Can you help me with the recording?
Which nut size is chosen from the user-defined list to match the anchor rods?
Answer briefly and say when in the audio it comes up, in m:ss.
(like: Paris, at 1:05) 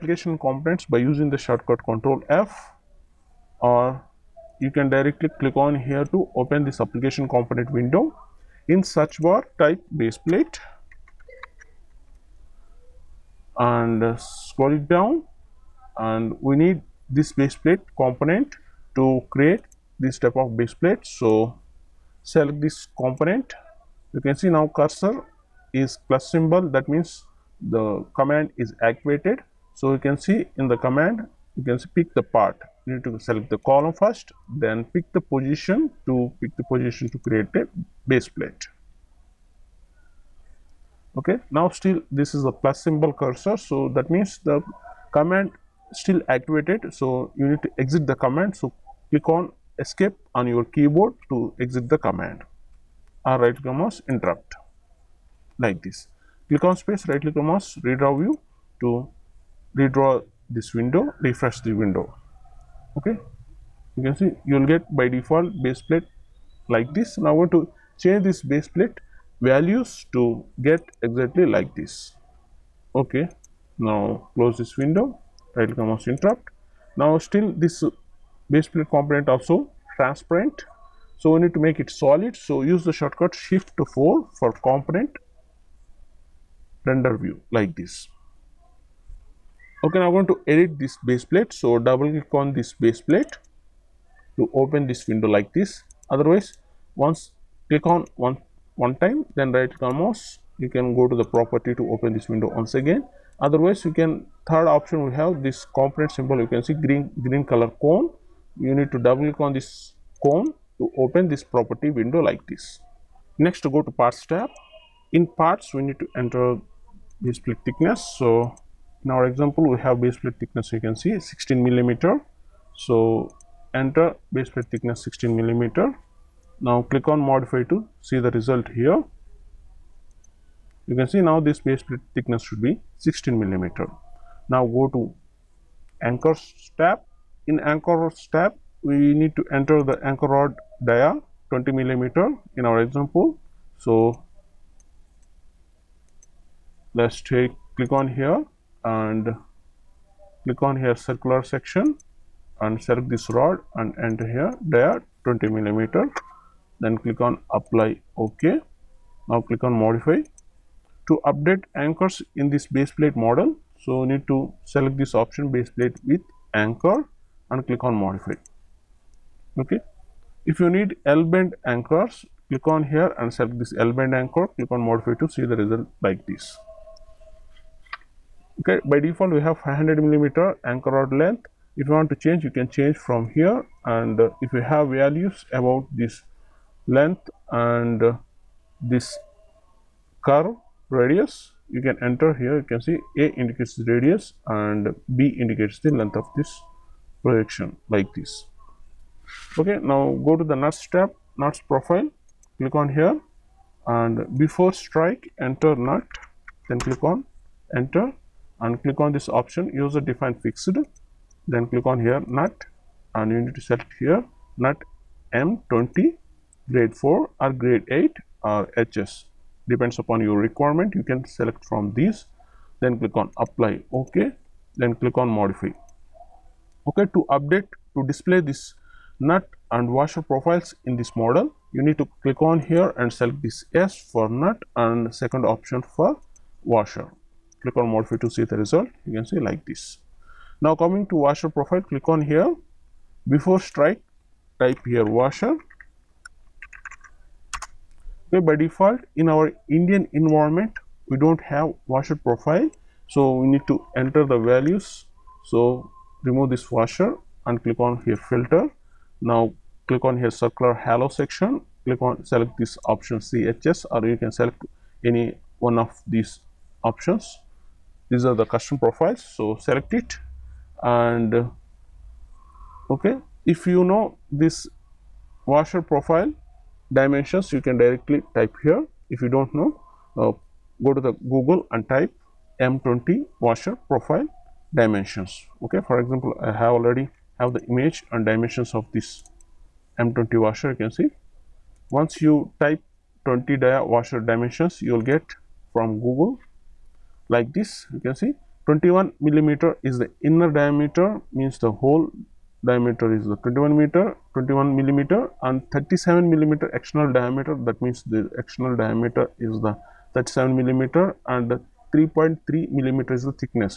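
M20, at 3:34.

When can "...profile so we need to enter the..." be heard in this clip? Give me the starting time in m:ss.
4:12.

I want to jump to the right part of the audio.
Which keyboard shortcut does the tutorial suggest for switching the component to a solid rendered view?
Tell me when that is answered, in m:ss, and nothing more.
1:23.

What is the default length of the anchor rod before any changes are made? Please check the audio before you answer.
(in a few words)
500 millimeter.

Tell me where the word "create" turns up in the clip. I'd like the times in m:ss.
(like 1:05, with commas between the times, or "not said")
0:19, 0:37.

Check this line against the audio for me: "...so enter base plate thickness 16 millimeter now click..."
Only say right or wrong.
right.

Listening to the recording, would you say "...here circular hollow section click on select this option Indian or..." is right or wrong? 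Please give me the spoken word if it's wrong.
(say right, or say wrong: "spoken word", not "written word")
wrong: "CHS", not "Indian".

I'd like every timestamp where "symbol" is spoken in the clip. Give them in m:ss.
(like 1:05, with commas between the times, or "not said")
0:26, 0:42, 1:46.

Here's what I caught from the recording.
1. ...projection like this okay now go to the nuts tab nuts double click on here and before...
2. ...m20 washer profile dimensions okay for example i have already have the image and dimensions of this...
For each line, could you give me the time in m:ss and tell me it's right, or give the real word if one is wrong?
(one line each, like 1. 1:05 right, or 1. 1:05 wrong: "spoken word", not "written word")
1. 3:17 wrong: "profile", not "double"
2. 4:42 right.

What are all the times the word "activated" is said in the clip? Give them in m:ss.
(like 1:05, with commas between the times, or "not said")
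0:28, 0:46.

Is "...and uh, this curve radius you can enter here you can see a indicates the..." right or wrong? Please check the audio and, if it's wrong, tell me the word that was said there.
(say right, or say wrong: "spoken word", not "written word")
right.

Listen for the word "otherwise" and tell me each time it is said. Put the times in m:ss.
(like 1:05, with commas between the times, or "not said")
1:36, 1:43.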